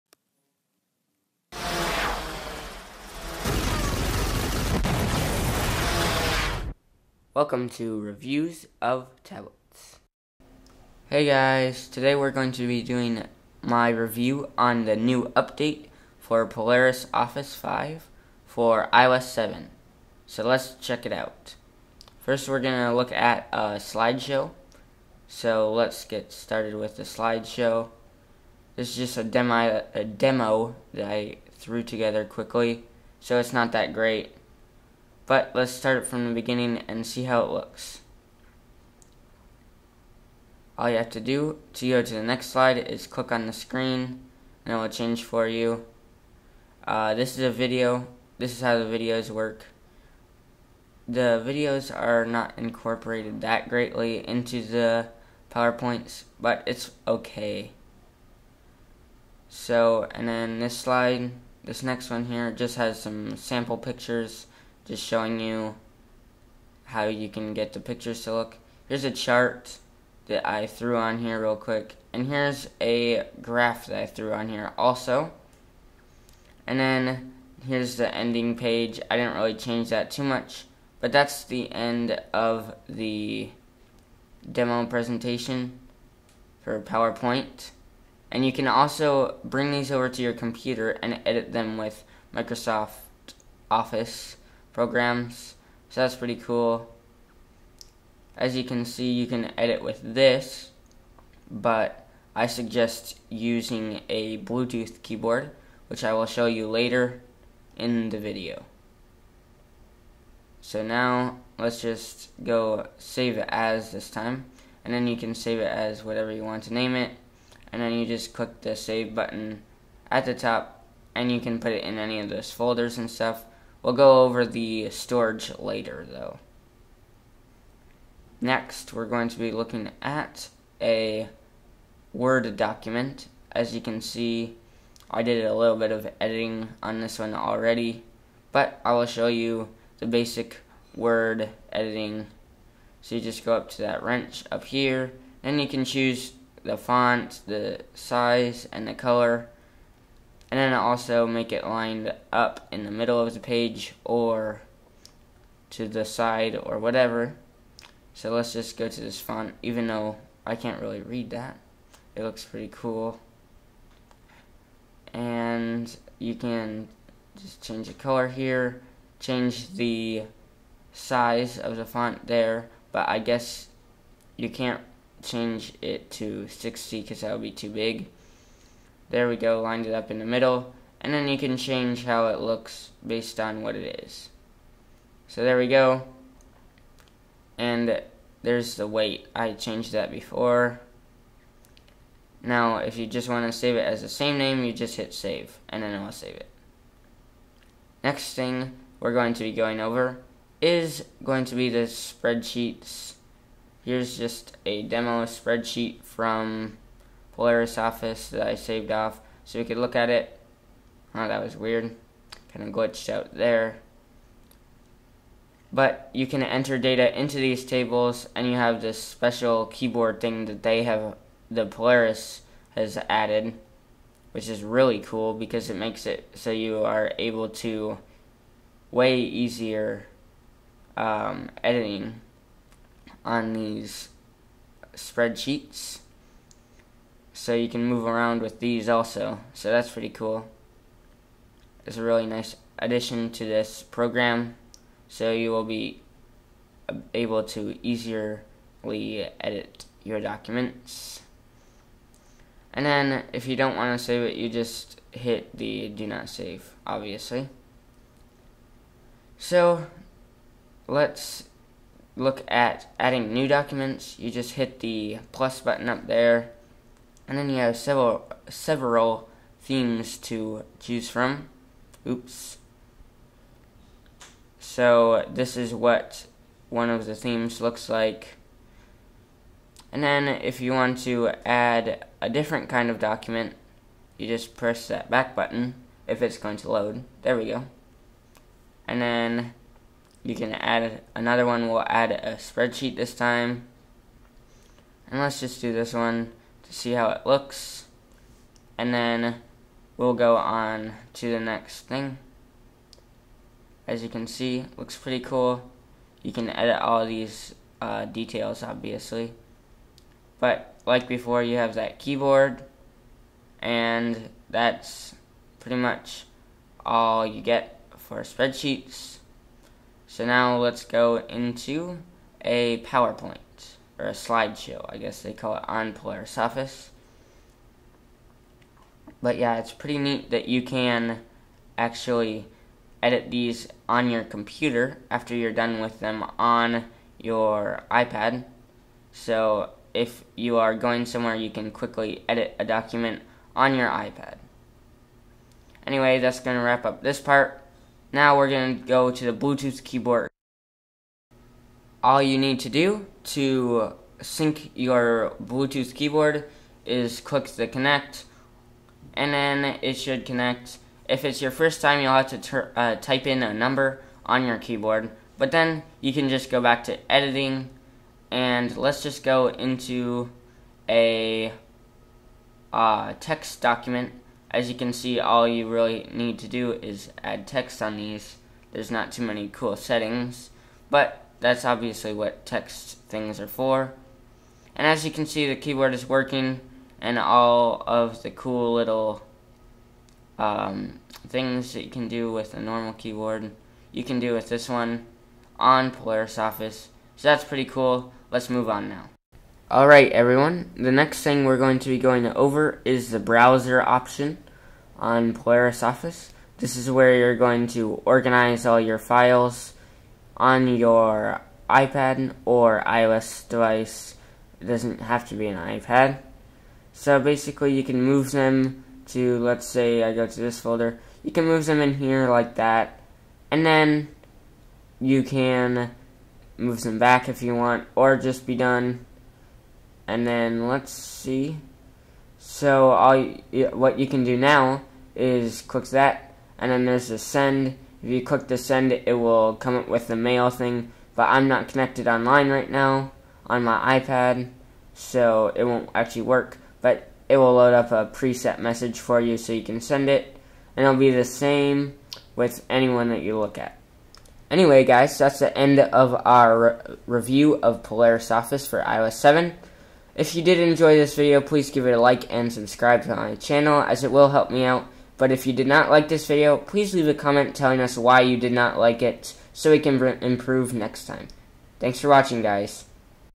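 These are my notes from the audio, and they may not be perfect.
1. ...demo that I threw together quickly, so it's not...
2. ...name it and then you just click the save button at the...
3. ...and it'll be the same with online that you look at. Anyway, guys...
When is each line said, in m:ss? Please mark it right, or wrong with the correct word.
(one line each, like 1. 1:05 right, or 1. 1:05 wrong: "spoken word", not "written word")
1. 0:30 right
2. 1:56 right
3. 7:30 wrong: "anyone", not "online".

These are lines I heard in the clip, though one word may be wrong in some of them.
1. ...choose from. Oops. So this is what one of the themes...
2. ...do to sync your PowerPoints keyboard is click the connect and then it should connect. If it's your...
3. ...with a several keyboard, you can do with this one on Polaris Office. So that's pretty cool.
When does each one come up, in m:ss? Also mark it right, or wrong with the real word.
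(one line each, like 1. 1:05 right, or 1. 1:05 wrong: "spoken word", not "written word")
1. 4:30 right
2. 5:52 wrong: "Bluetooth", not "PowerPoints"
3. 6:32 wrong: "normal", not "several".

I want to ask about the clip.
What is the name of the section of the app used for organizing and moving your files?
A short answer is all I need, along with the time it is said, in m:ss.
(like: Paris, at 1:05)
browser, at 6:43.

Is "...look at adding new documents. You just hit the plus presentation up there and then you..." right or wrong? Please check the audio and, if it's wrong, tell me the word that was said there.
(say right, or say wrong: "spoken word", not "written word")
wrong: "button", not "presentation".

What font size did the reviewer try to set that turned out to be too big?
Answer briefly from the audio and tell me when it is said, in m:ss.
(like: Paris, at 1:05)
60, at 2:56.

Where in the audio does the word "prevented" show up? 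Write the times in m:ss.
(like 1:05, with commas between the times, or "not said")
not said.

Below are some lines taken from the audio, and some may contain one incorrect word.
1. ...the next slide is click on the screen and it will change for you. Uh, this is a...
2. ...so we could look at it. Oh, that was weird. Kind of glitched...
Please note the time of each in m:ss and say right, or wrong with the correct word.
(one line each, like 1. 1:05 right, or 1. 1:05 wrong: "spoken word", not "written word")
1. 0:42 right
2. 3:29 right.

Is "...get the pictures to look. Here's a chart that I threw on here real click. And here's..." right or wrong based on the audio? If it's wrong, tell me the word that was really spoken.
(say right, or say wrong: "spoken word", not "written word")
wrong: "quick", not "click".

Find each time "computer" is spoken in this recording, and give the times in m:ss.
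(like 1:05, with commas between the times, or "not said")
1:30, 5:34.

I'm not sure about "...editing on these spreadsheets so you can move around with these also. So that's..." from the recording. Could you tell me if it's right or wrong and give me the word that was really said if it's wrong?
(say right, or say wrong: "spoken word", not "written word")
right.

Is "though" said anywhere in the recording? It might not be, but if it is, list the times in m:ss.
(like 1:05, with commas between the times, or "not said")
2:06, 2:39.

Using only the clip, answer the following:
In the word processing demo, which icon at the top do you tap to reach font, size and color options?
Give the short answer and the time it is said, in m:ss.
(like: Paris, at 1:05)
wrench, at 2:24.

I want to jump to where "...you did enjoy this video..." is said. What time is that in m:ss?
7:40.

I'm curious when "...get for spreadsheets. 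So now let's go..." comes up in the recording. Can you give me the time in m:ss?
5:17.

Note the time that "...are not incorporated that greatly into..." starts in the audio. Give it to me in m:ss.
0:51.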